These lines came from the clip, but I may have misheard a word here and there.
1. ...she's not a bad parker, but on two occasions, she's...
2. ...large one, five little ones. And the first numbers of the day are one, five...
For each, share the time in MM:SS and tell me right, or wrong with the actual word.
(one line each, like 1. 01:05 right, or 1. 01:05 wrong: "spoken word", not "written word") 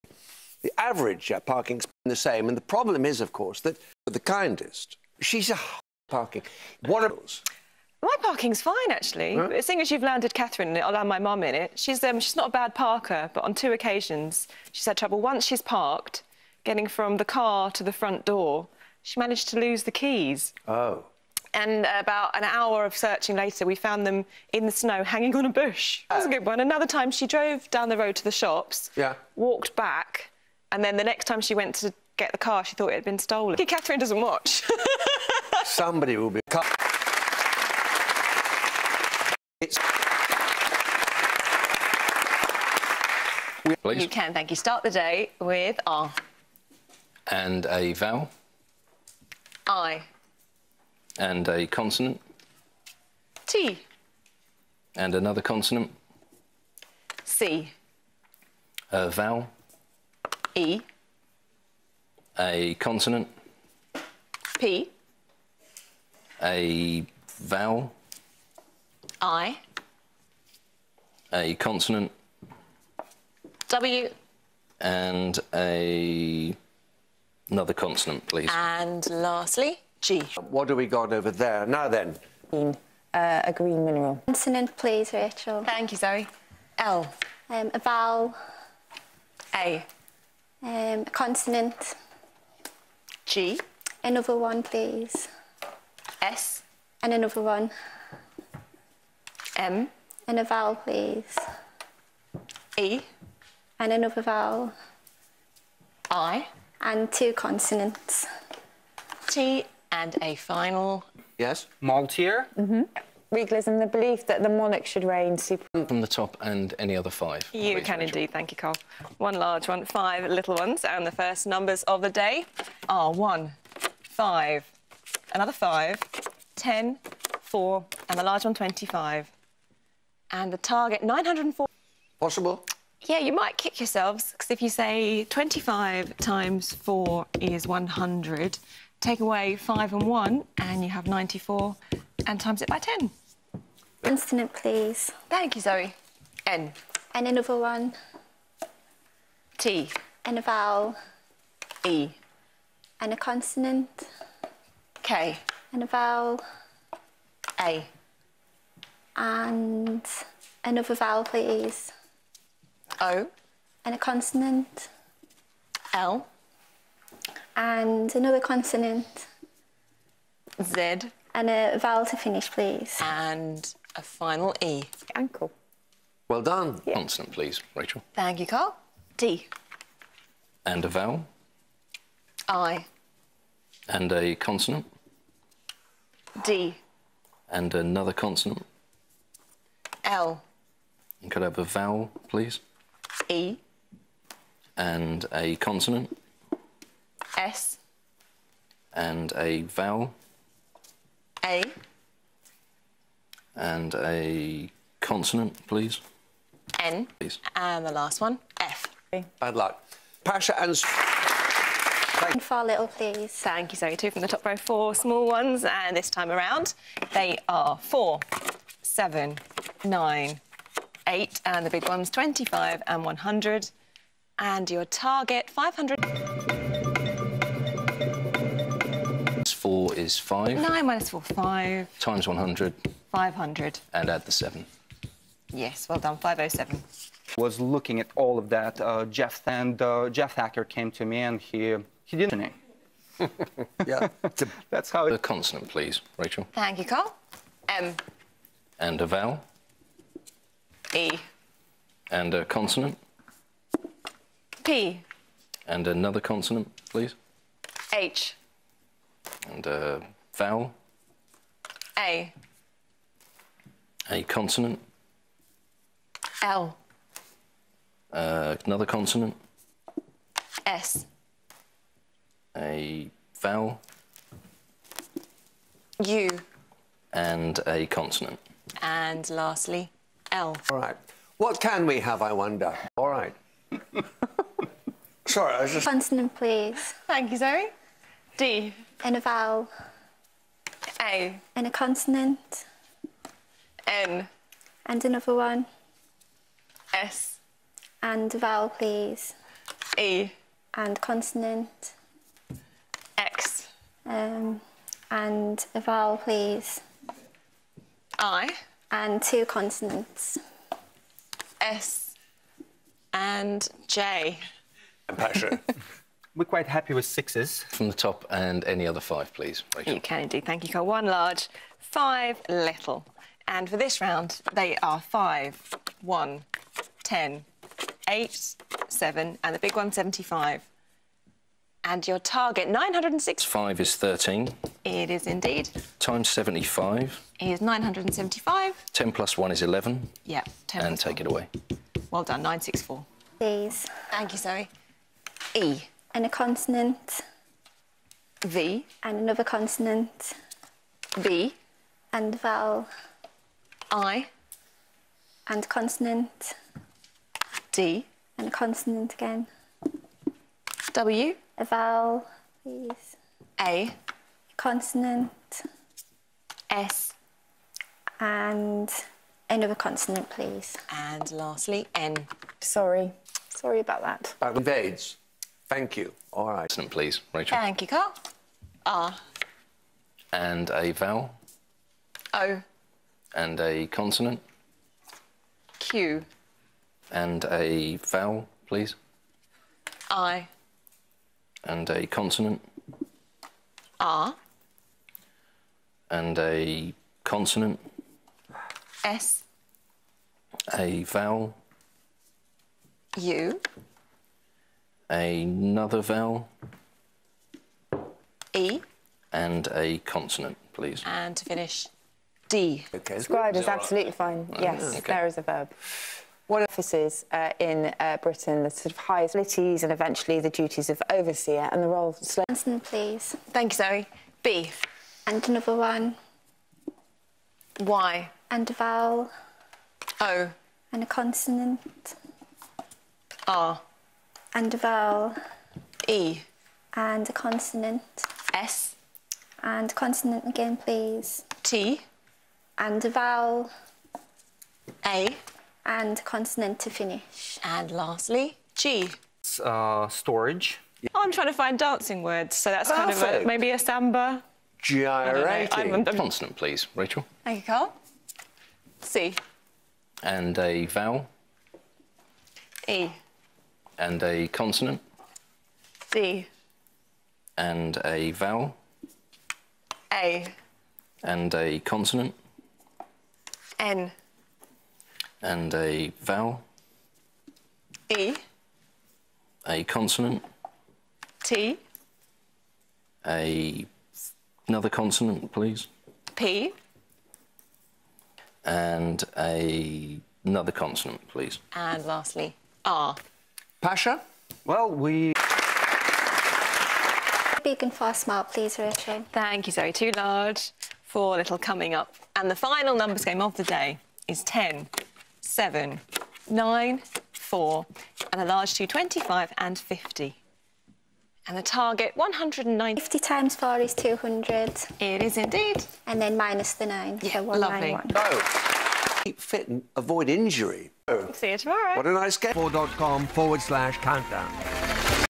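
1. 00:12 right
2. 01:59 right.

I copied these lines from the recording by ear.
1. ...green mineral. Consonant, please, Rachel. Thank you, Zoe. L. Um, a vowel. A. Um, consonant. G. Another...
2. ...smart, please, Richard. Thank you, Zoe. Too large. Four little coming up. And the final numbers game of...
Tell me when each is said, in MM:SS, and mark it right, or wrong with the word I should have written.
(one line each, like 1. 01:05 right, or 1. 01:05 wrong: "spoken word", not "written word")
1. 01:23 right
2. 08:18 right.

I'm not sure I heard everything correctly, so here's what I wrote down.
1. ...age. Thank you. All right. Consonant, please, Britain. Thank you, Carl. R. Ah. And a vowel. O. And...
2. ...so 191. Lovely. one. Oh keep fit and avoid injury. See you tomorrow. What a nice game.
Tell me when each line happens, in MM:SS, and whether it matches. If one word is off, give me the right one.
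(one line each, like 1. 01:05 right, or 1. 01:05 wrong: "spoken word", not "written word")
1. 06:14 wrong: "Rachel", not "Britain"
2. 08:37 right.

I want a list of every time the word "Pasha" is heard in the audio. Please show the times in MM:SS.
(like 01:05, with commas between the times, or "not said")
03:30, 08:13.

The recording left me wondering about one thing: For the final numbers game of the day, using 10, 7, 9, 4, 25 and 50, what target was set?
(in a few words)
190.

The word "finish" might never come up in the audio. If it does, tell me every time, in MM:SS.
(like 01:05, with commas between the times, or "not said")
02:52, 06:51, 07:26.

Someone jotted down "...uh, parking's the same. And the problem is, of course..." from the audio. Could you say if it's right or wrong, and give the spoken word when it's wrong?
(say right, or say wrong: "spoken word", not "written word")
right.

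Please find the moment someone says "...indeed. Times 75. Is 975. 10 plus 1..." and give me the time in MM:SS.
05:35.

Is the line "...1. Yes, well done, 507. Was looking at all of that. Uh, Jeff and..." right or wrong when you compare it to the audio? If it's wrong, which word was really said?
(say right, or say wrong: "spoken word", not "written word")
wrong: "7", not "1".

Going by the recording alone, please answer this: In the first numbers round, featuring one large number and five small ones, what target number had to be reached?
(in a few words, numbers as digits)
904.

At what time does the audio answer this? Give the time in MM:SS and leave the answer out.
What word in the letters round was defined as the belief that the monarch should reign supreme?
01:53.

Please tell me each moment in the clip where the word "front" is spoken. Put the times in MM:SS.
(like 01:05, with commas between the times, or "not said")
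00:17.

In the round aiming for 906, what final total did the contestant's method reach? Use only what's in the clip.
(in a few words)
964.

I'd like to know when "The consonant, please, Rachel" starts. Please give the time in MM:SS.
04:05.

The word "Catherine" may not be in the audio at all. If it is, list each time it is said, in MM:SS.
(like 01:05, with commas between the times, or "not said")
00:10, 00:33.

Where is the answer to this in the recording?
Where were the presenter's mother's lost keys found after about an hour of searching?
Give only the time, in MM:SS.
00:24.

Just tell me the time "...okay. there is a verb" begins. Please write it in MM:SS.
06:54.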